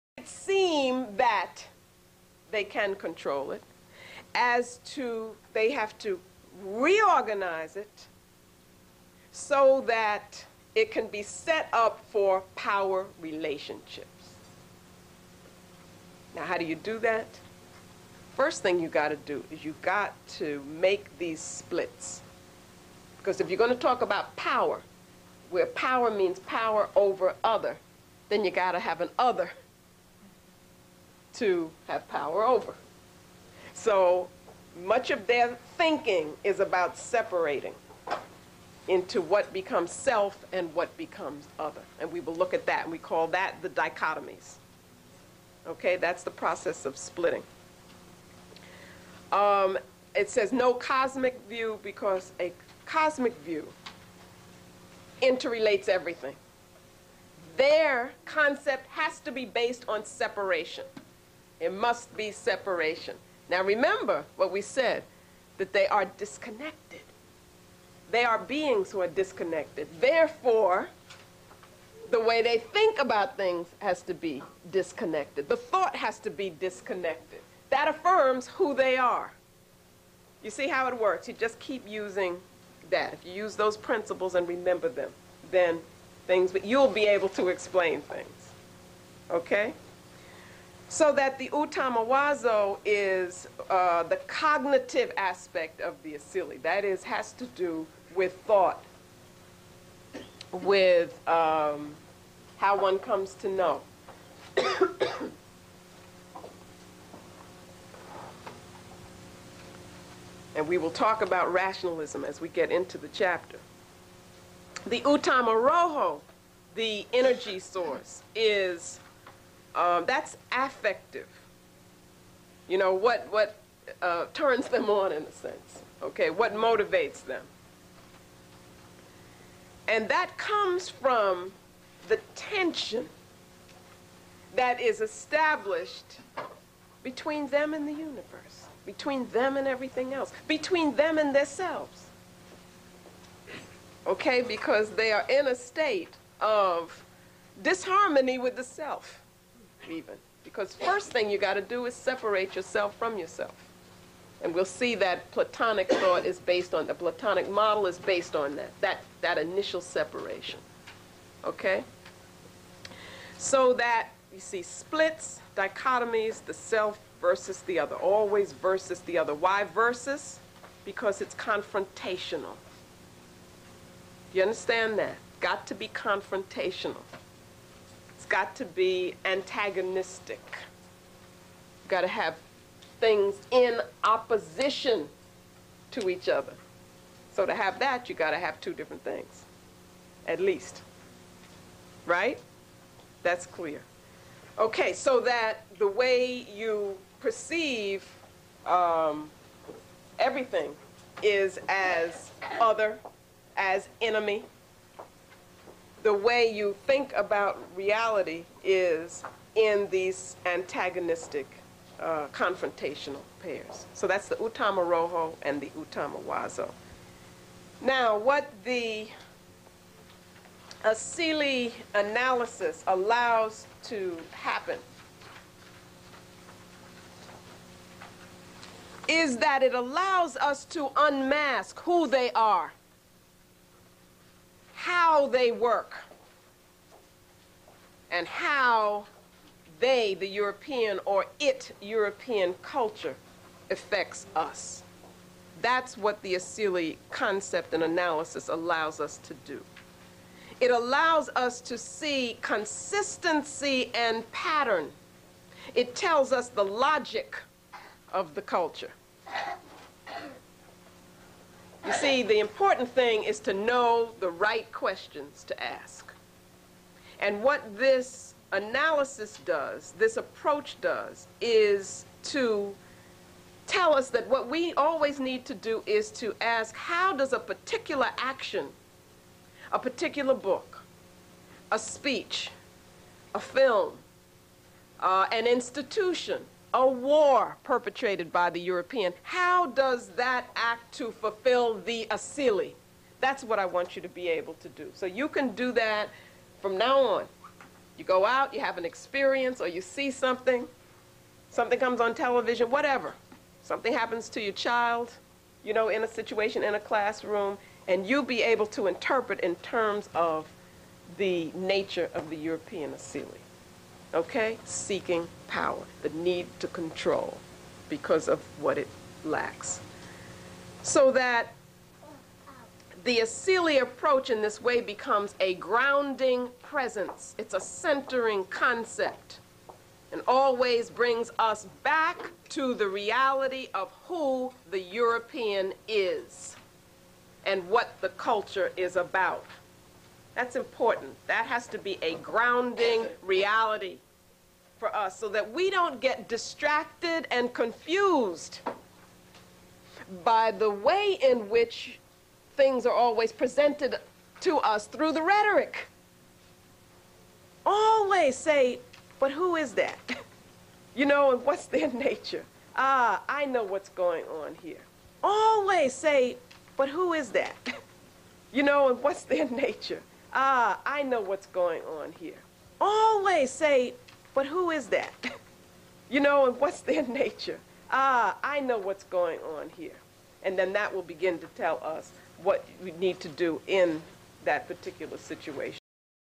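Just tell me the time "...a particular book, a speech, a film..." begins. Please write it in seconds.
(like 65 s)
279 s.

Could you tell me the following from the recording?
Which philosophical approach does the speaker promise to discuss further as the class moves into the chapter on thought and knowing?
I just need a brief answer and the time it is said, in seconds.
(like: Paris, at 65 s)
rationalism, at 111 s.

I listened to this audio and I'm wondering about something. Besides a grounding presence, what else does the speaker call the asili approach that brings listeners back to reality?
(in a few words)
a centering concept.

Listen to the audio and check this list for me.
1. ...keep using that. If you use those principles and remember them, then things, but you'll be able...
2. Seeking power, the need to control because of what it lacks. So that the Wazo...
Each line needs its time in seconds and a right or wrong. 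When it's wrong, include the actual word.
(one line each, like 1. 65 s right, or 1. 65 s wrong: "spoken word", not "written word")
1. 81 s right
2. 314 s wrong: "Asili", not "Wazo".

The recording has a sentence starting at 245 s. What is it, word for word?
That's what the Asili concept and analysis allows us to do.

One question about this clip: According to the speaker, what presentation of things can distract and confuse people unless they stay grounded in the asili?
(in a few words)
the rhetoric.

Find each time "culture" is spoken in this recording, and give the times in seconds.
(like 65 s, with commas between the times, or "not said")
242 s, 258 s, 338 s.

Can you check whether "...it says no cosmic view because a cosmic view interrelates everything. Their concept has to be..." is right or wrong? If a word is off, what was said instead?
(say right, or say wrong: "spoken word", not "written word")
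right.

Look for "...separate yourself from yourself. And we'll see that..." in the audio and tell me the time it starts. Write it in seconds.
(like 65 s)
151 s.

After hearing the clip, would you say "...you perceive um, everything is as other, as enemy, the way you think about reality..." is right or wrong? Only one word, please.
right.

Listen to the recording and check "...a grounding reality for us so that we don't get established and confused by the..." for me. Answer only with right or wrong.
wrong.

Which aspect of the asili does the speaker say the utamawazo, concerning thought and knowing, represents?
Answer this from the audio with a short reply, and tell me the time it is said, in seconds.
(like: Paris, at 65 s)
the cognitive aspect, at 94 s.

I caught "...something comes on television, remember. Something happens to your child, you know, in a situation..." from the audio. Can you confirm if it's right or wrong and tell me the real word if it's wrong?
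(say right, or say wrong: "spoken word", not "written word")
wrong: "whatever", not "remember".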